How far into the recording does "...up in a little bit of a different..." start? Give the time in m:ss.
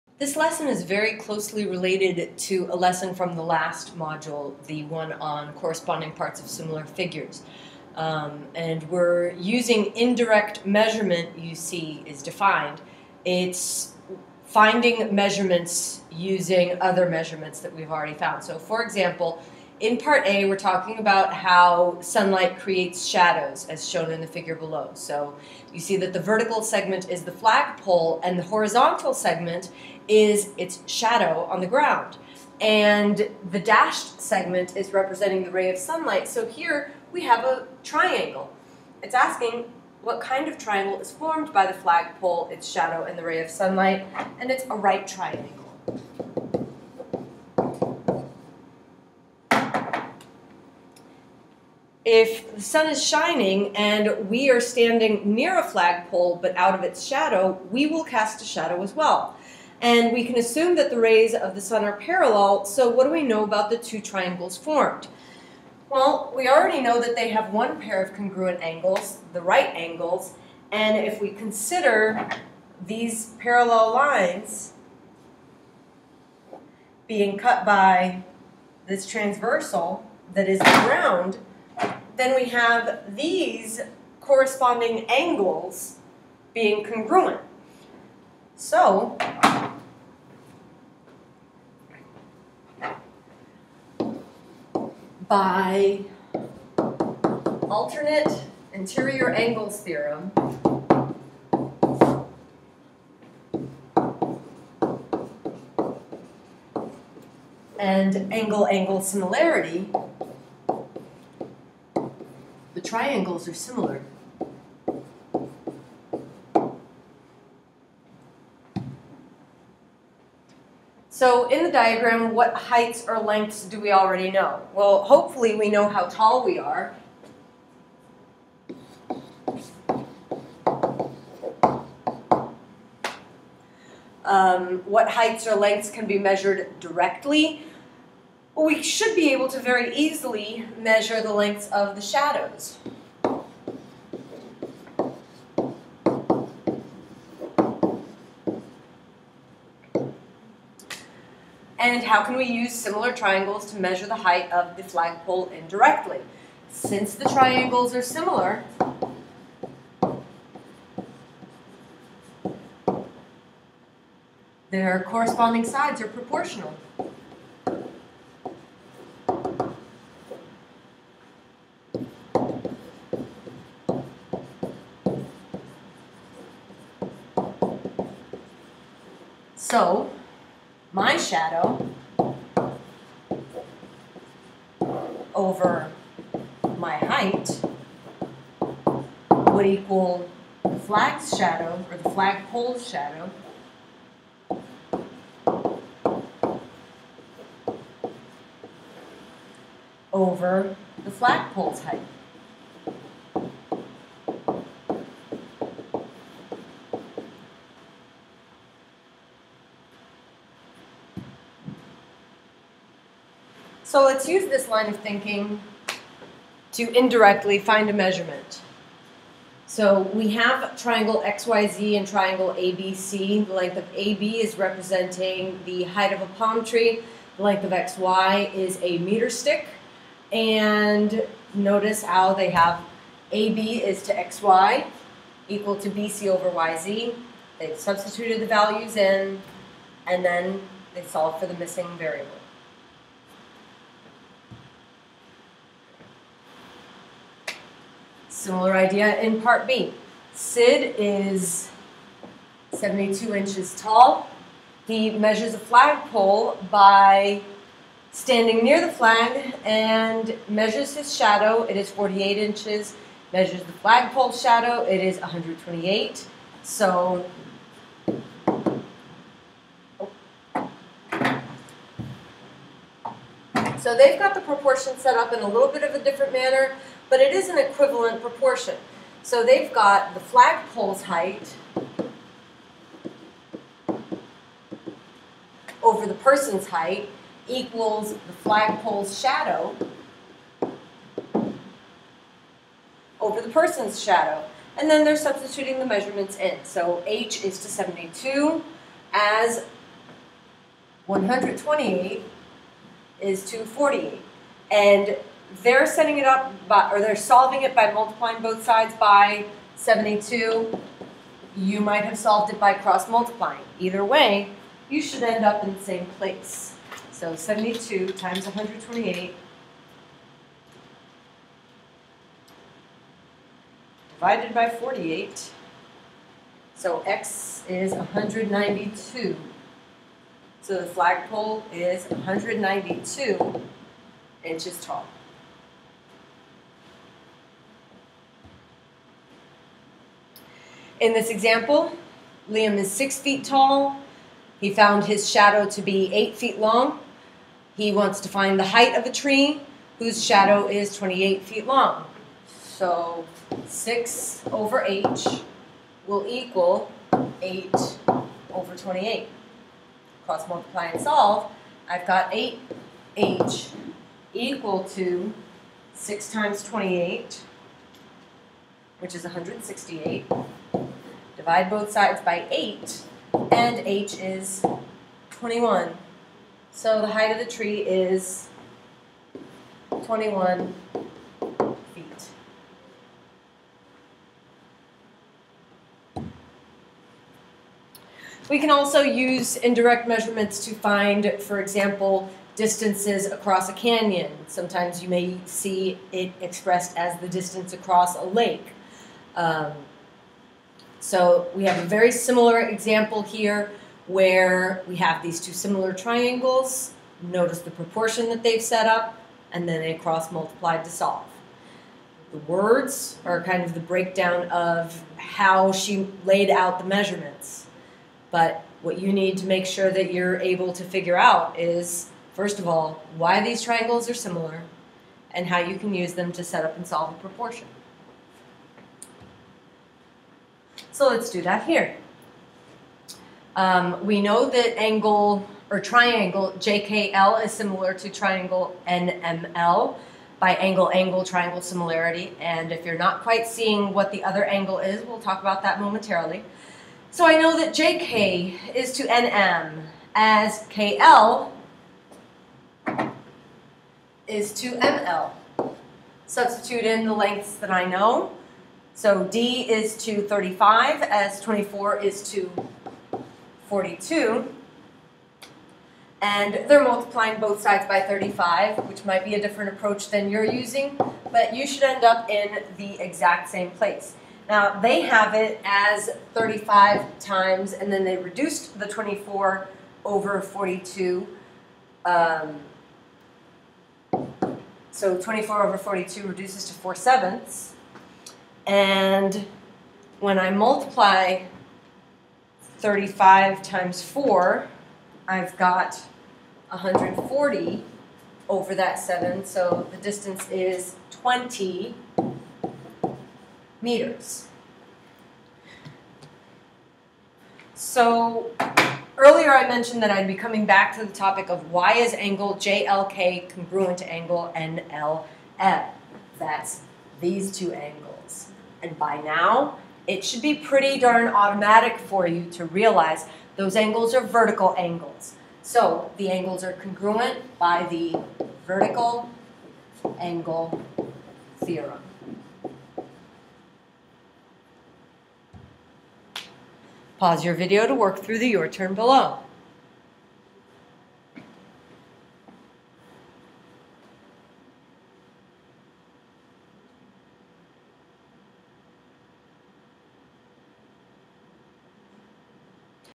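4:35.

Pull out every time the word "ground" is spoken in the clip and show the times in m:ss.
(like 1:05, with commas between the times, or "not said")
0:31, 1:20.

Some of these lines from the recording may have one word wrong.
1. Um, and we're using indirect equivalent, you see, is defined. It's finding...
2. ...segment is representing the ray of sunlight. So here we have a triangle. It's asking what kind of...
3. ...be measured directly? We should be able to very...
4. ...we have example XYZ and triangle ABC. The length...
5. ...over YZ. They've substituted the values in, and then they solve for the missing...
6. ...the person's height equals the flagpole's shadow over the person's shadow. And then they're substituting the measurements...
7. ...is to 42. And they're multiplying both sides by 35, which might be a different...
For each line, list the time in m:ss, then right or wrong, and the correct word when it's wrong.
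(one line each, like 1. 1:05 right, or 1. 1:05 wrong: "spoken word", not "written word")
1. 0:07 wrong: "measurement", not "equivalent"
2. 0:34 right
3. 2:16 right
4. 3:40 wrong: "triangle", not "example"
5. 3:56 right
6. 4:46 right
7. 7:41 right.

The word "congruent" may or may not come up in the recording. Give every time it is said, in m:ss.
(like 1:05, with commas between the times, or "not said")
1:08, 1:26, 8:33, 8:46.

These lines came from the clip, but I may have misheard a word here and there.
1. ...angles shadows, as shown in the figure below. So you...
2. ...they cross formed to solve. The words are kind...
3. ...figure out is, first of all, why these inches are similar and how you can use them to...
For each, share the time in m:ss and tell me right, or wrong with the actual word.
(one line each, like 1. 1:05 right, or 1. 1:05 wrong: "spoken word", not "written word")
1. 0:22 wrong: "creates", not "angles"
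2. 6:49 wrong: "multiplied", not "formed"
3. 7:00 wrong: "triangles", not "inches".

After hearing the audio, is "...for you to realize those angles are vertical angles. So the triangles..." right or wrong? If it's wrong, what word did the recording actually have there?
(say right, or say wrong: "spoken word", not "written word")
wrong: "angles", not "triangles".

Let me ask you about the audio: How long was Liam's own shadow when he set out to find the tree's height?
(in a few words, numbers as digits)
8 feet.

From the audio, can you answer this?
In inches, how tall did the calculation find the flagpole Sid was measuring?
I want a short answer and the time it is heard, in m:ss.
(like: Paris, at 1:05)
192, at 5:32.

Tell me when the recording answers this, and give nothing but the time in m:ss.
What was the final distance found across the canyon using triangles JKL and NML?
8:21.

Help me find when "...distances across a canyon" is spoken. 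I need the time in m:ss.
6:32.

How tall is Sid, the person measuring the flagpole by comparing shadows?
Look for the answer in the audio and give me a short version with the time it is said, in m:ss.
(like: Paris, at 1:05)
72 inches, at 4:12.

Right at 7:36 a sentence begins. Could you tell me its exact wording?
Substitute in the lengths that I know.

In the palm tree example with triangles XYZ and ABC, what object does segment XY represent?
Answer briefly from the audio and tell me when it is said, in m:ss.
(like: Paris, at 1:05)
a meter stick, at 3:48.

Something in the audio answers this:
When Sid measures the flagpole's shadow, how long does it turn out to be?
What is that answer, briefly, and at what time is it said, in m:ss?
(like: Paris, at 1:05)
128, at 4:24.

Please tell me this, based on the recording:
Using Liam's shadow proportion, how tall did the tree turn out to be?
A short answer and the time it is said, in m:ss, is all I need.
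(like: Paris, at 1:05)
21 feet, at 6:20.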